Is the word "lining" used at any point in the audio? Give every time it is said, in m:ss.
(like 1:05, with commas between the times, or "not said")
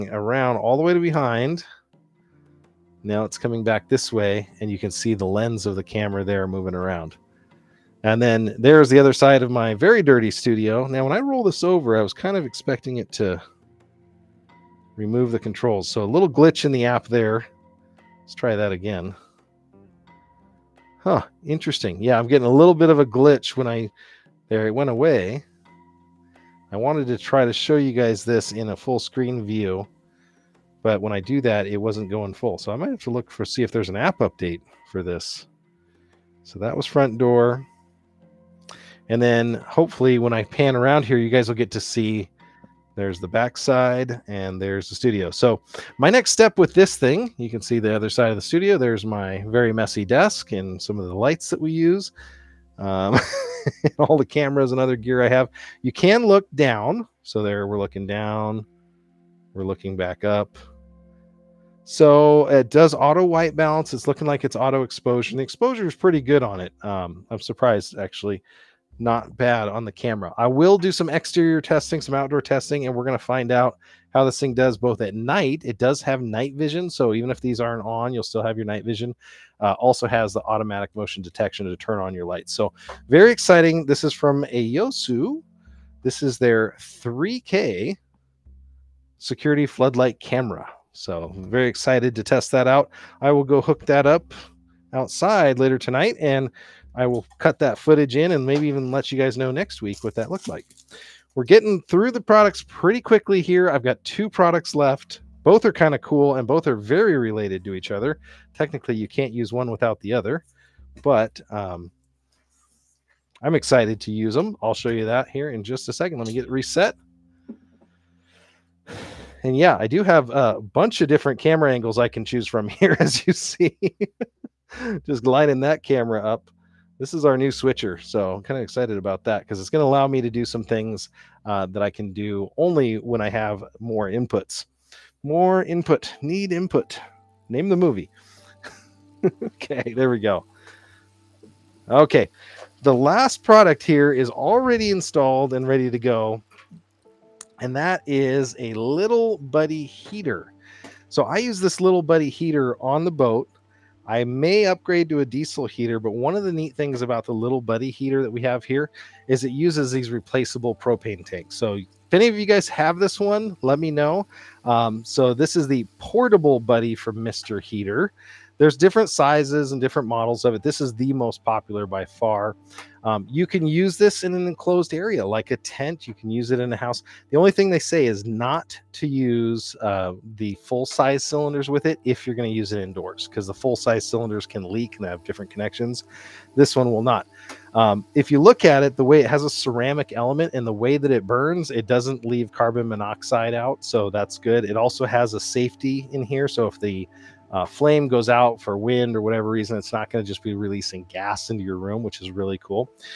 2:05.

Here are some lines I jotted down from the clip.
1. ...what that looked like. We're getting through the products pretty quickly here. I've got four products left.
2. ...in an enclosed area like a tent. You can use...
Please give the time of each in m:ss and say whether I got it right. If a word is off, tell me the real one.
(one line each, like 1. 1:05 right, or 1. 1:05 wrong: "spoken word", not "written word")
1. 1:40 wrong: "two", not "four"
2. 2:54 right.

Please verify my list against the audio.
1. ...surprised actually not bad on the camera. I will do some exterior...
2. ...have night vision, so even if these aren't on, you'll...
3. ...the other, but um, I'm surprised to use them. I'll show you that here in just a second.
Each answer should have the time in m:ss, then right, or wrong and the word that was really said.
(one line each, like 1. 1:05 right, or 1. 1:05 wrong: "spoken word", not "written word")
1. 1:07 right
2. 1:16 right
3. 1:49 wrong: "excited", not "surprised".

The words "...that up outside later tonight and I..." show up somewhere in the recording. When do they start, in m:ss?
1:33.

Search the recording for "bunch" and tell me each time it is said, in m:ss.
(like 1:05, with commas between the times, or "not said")
2:00.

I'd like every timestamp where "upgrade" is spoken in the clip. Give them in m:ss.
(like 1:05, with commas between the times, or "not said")
2:34.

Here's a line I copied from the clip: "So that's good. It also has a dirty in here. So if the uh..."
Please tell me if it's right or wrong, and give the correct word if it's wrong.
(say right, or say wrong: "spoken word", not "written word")
wrong: "safety", not "dirty".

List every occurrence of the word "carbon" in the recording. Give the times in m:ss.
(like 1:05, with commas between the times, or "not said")
3:12.